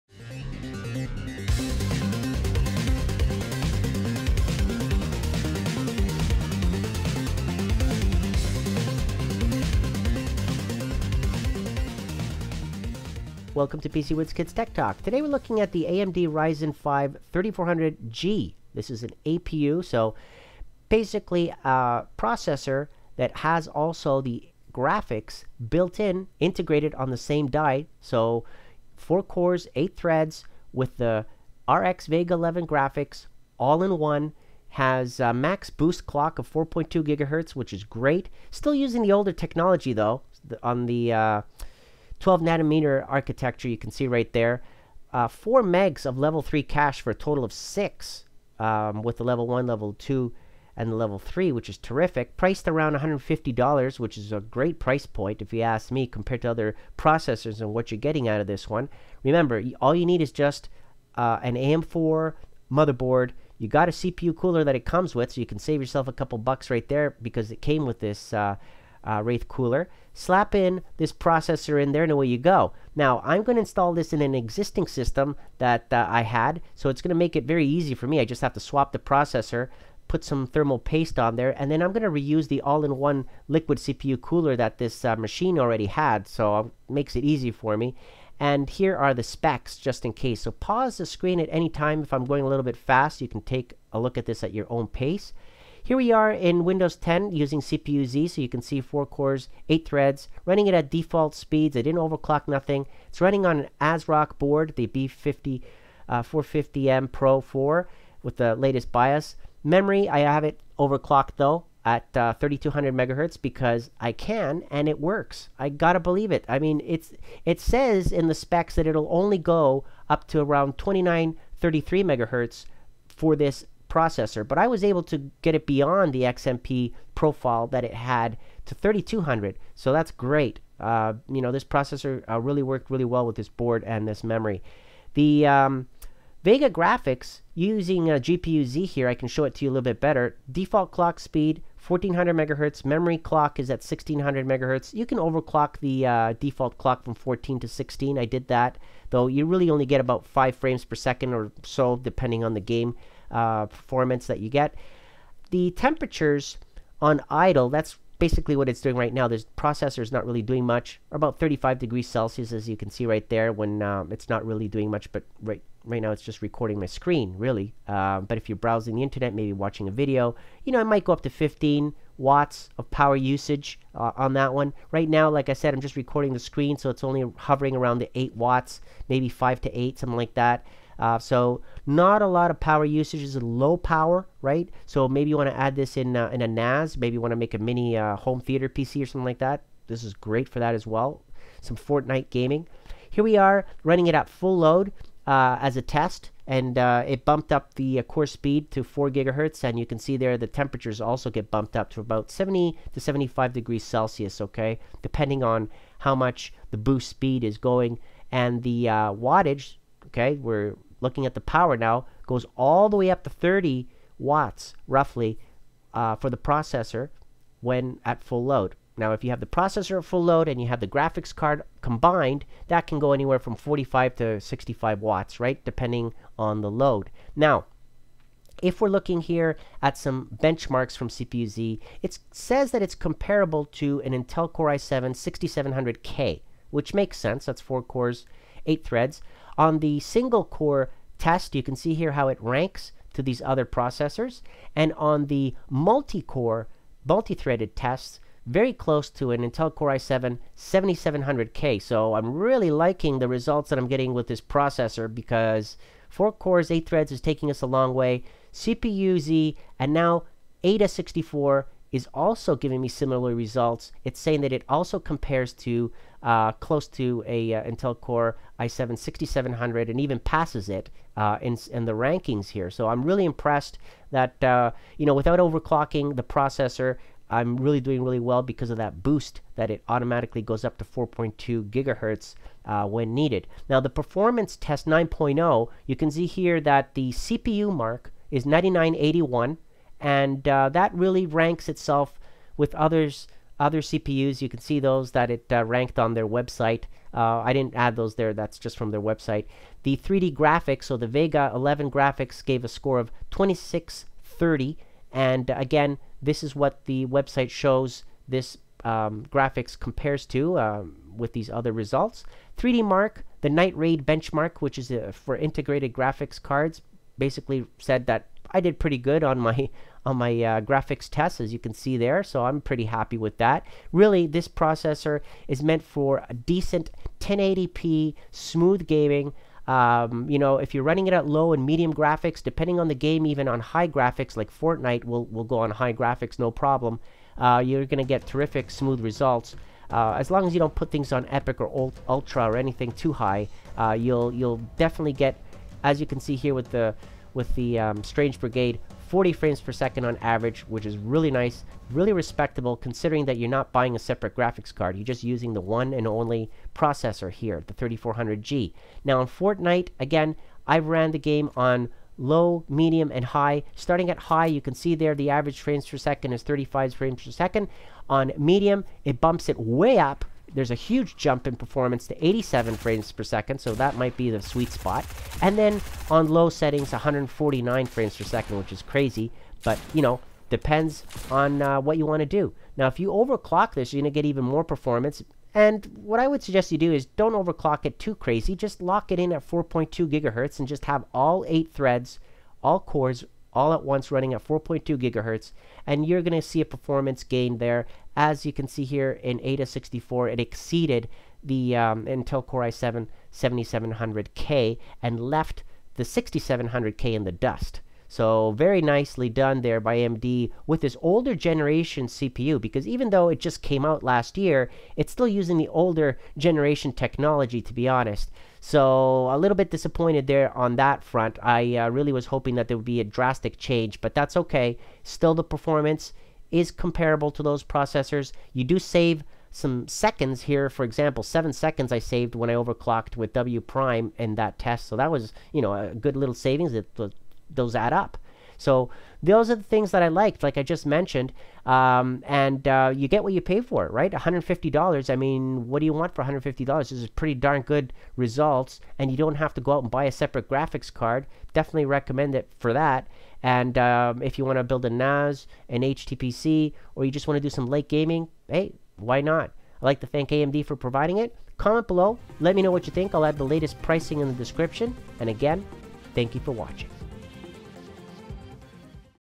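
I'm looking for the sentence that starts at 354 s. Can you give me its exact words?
You're just using the one and only processor here, the 3400G.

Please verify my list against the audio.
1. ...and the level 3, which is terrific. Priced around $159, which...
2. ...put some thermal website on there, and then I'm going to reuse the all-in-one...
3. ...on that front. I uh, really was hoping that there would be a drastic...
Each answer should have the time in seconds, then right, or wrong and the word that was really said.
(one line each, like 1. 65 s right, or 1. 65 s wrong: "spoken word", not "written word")
1. 50 s wrong: "150", not "159"
2. 80 s wrong: "paste", not "website"
3. 420 s right.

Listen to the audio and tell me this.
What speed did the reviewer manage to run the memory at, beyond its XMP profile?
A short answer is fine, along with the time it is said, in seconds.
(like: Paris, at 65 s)
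3200 MHz, at 112 s.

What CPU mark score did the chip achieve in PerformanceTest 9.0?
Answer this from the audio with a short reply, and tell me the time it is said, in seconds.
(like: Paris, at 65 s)
9981, at 288 s.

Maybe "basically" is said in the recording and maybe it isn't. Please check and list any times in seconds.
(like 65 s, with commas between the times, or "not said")
20 s, 158 s, 317 s.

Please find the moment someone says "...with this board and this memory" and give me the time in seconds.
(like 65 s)
133 s.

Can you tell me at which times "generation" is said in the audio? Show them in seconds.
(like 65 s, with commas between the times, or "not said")
411 s, 416 s.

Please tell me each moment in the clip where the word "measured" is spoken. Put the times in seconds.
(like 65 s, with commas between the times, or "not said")
not said.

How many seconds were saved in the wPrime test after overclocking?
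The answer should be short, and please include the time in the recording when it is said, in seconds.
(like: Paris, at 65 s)
7, at 431 s.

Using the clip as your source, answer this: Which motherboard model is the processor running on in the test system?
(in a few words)
B450M Pro 4.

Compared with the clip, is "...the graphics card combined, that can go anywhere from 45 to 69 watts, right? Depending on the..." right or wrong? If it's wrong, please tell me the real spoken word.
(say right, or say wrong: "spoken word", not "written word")
wrong: "65", not "69".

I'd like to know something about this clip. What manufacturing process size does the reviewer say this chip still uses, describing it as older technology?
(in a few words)
12 nanometer.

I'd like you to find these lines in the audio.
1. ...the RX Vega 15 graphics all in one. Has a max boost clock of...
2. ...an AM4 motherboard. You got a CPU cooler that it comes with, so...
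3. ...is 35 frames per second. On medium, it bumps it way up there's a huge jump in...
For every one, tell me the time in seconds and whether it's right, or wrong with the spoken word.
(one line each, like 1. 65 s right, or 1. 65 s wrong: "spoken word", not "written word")
1. 30 s wrong: "11", not "15"
2. 61 s right
3. 366 s right.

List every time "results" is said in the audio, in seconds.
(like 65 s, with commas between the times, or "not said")
253 s, 263 s, 311 s, 338 s, 448 s.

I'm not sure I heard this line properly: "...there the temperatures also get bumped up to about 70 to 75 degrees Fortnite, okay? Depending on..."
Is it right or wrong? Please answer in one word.
wrong.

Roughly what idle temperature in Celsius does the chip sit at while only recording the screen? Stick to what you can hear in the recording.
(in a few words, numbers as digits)
35 degrees.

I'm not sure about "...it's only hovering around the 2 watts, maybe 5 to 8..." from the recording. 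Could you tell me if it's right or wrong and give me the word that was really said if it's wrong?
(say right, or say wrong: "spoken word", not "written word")
wrong: "8", not "2".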